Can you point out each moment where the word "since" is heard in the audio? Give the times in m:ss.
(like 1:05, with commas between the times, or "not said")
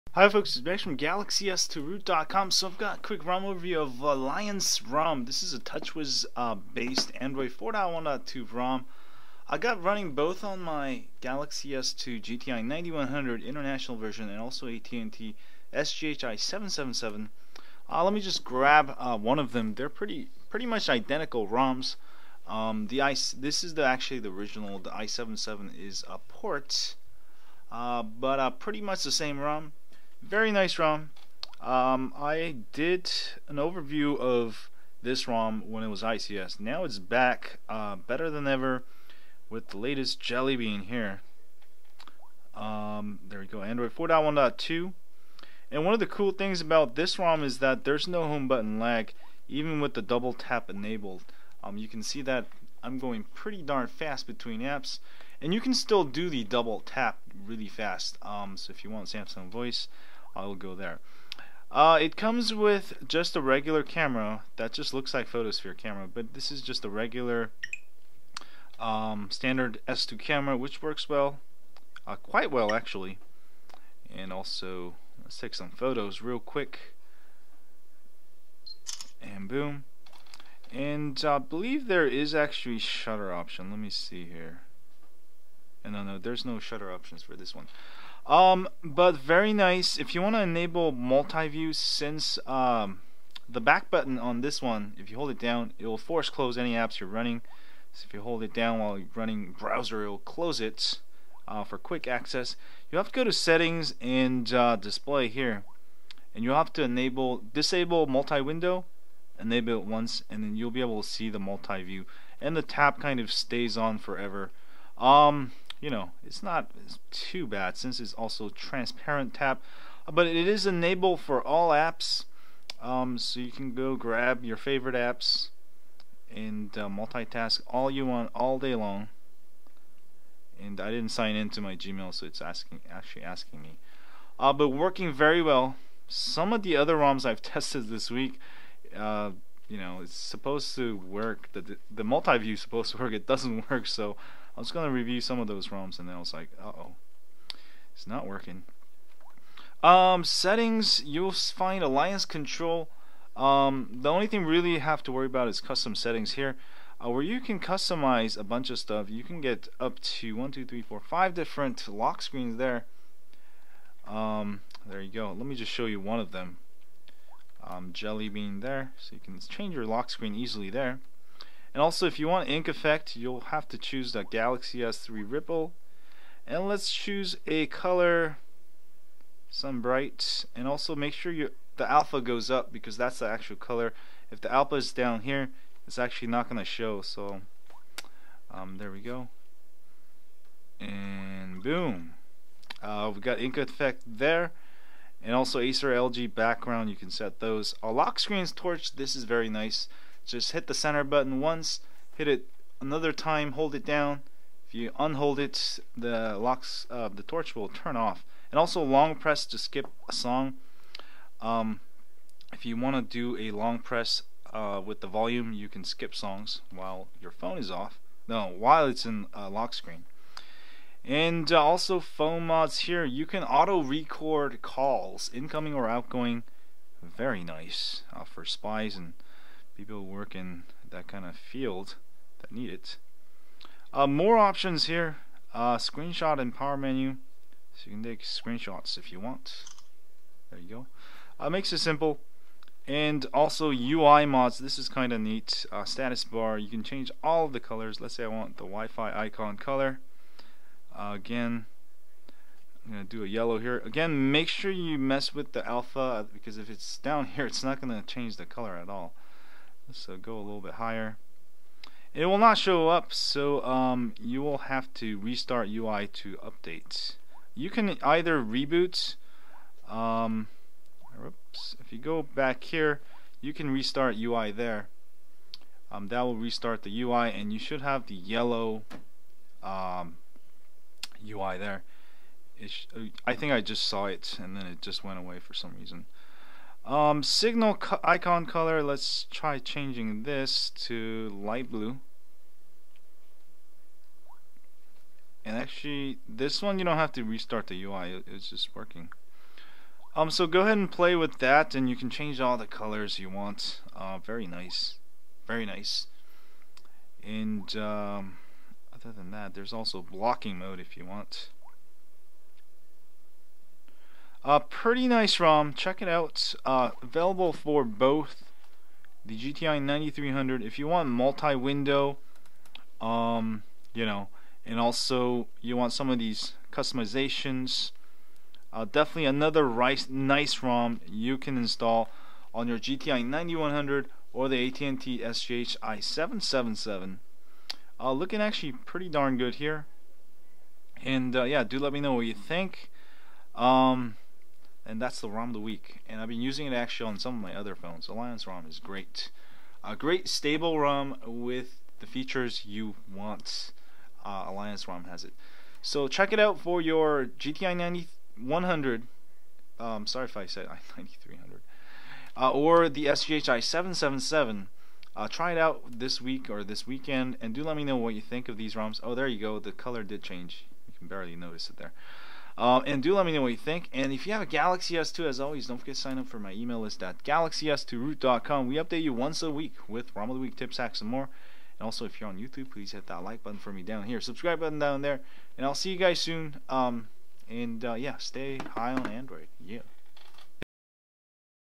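1:31, 1:57.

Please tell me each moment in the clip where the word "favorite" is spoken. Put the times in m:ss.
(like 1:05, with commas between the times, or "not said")
2:04.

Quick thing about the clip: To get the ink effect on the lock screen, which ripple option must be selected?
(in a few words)
Galaxy S3 Ripple.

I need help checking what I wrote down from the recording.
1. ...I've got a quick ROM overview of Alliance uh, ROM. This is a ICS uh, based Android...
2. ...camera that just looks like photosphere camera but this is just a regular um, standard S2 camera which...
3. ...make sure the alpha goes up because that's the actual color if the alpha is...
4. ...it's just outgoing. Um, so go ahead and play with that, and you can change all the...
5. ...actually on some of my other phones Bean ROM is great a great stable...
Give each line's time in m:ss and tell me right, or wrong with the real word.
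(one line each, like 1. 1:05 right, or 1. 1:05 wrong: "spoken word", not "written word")
1. 0:02 wrong: "TouchWiz", not "ICS"
2. 1:03 right
3. 3:00 right
4. 4:58 wrong: "working", not "outgoing"
5. 5:46 wrong: "Alliance", not "Bean".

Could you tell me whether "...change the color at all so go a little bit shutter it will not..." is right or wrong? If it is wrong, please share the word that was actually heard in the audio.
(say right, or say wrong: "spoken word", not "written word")
wrong: "higher", not "shutter".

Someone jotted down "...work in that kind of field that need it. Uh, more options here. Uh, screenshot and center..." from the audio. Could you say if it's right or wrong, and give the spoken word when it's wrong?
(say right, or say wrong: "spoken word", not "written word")
wrong: "power", not "center".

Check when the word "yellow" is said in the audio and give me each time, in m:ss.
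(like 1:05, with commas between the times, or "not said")
4:13, 4:38.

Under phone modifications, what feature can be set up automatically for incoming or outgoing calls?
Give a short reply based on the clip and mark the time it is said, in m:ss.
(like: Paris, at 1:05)
Auto record calls, at 3:43.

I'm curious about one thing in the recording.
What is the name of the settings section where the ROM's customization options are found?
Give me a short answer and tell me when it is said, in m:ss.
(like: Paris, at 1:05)
Alliance Control, at 2:31.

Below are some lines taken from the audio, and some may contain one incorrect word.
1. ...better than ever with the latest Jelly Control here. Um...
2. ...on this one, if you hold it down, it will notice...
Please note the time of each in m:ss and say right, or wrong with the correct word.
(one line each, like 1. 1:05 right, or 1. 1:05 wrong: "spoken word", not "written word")
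1. 0:37 wrong: "Bean", not "Control"
2. 1:34 wrong: "force", not "notice".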